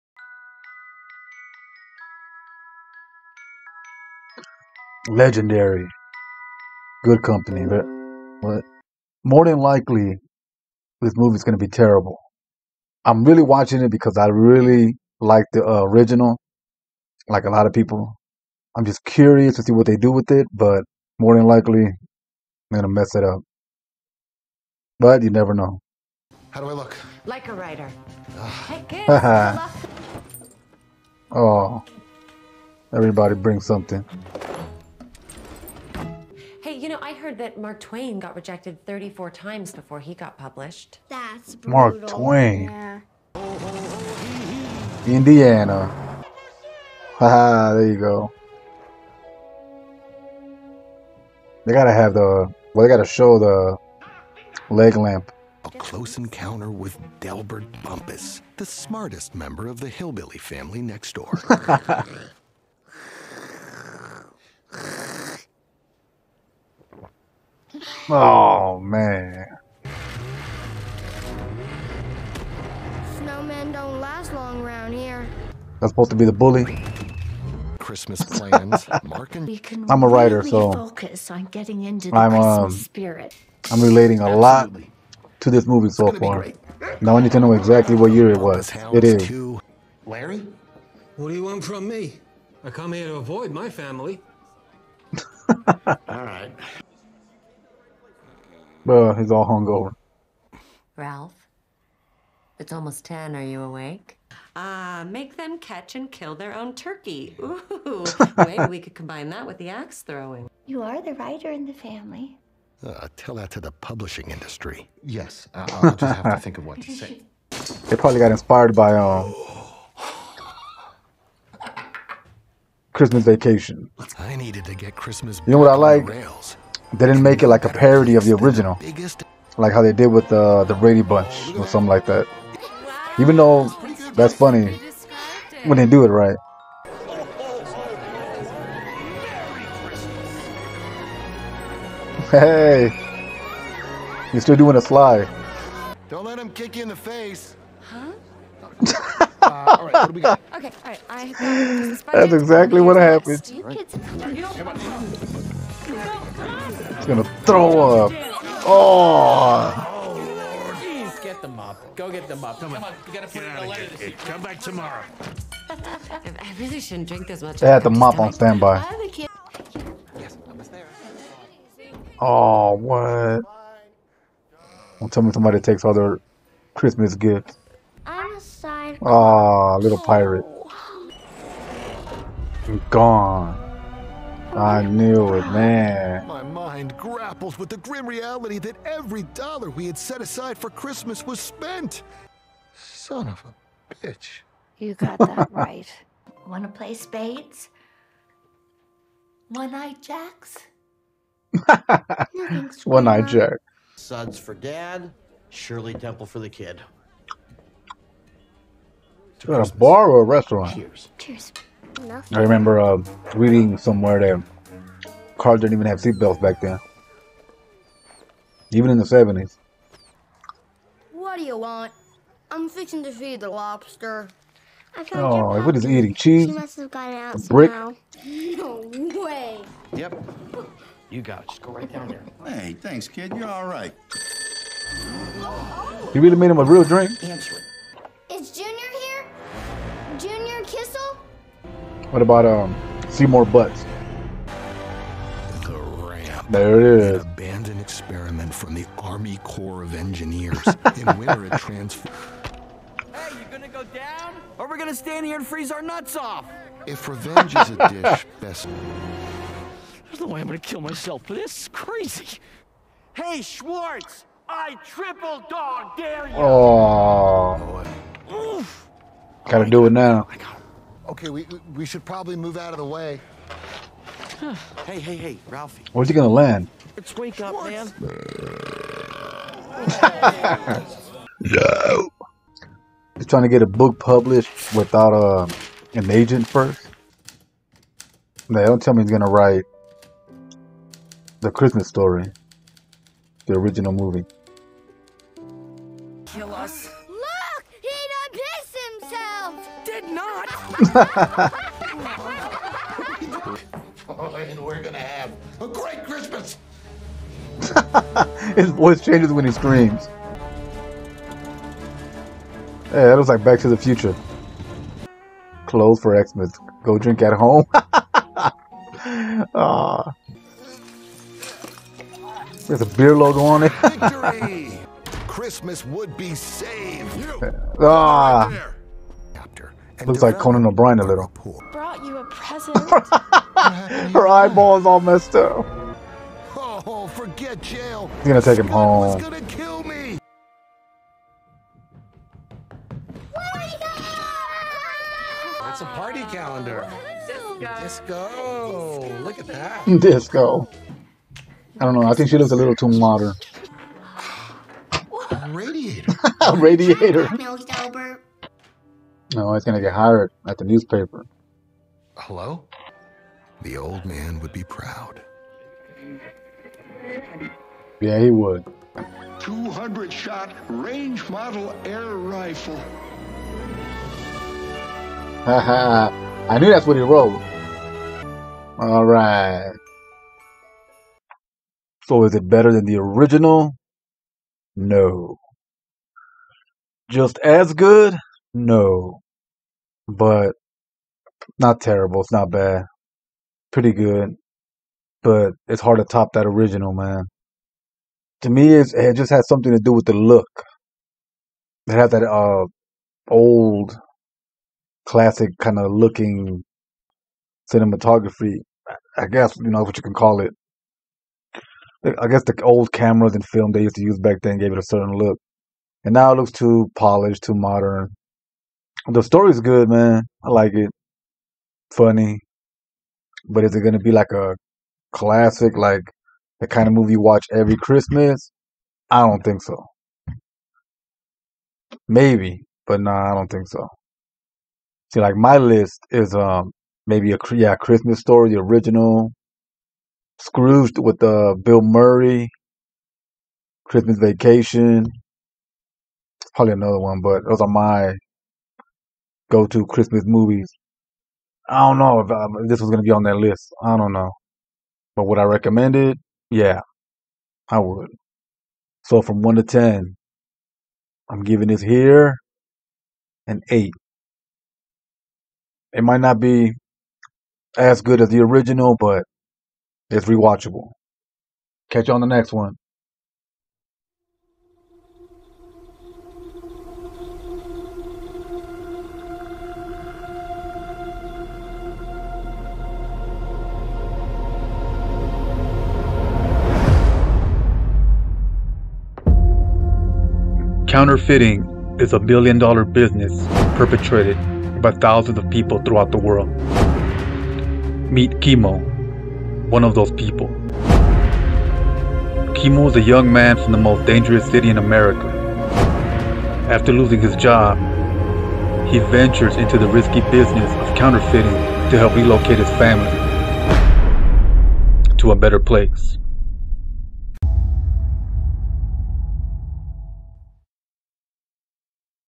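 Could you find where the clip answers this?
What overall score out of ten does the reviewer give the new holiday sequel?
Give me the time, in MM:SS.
07:43.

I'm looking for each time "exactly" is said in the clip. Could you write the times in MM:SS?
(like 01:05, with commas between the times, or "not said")
01:27, 02:32.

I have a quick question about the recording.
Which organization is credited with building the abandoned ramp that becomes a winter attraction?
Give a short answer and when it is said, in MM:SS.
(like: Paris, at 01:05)
Army Corps of Engineers, at 04:08.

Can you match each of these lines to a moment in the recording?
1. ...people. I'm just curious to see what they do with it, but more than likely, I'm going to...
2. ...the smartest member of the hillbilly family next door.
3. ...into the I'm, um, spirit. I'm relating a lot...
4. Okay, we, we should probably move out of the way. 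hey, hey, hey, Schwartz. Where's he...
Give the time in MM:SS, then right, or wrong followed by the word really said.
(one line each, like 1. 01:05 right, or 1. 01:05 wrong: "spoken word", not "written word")
1. 00:17 right
2. 00:58 right
3. 01:21 right
4. 04:31 wrong: "Ralphie", not "Schwartz".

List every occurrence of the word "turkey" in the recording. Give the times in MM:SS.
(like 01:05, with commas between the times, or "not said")
01:46.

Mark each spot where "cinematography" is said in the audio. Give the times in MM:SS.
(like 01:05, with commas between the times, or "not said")
06:47.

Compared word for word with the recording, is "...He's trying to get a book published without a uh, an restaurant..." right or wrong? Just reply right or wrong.
wrong.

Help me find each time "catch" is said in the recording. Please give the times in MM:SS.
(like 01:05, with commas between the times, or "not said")
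01:45, 07:51.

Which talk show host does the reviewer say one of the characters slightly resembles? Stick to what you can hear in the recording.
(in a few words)
Conan O'Brien.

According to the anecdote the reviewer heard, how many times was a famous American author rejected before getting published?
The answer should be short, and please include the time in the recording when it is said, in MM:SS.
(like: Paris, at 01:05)
34, at 00:38.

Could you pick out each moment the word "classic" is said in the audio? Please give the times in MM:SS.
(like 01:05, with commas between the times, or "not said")
06:45, 07:05.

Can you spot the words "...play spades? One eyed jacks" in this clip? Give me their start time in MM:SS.
03:16.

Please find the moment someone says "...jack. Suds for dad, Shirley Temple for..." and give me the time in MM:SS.
03:23.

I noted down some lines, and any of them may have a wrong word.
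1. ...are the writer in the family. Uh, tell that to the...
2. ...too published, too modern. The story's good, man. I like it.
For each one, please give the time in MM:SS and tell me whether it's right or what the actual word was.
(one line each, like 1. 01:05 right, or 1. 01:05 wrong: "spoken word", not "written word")
1. 01:50 right
2. 06:56 wrong: "polished", not "published".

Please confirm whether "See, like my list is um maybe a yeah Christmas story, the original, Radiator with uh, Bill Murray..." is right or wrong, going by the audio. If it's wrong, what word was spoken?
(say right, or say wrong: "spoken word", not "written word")
wrong: "Scrooge", not "Radiator".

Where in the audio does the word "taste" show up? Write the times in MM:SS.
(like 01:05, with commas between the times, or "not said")
not said.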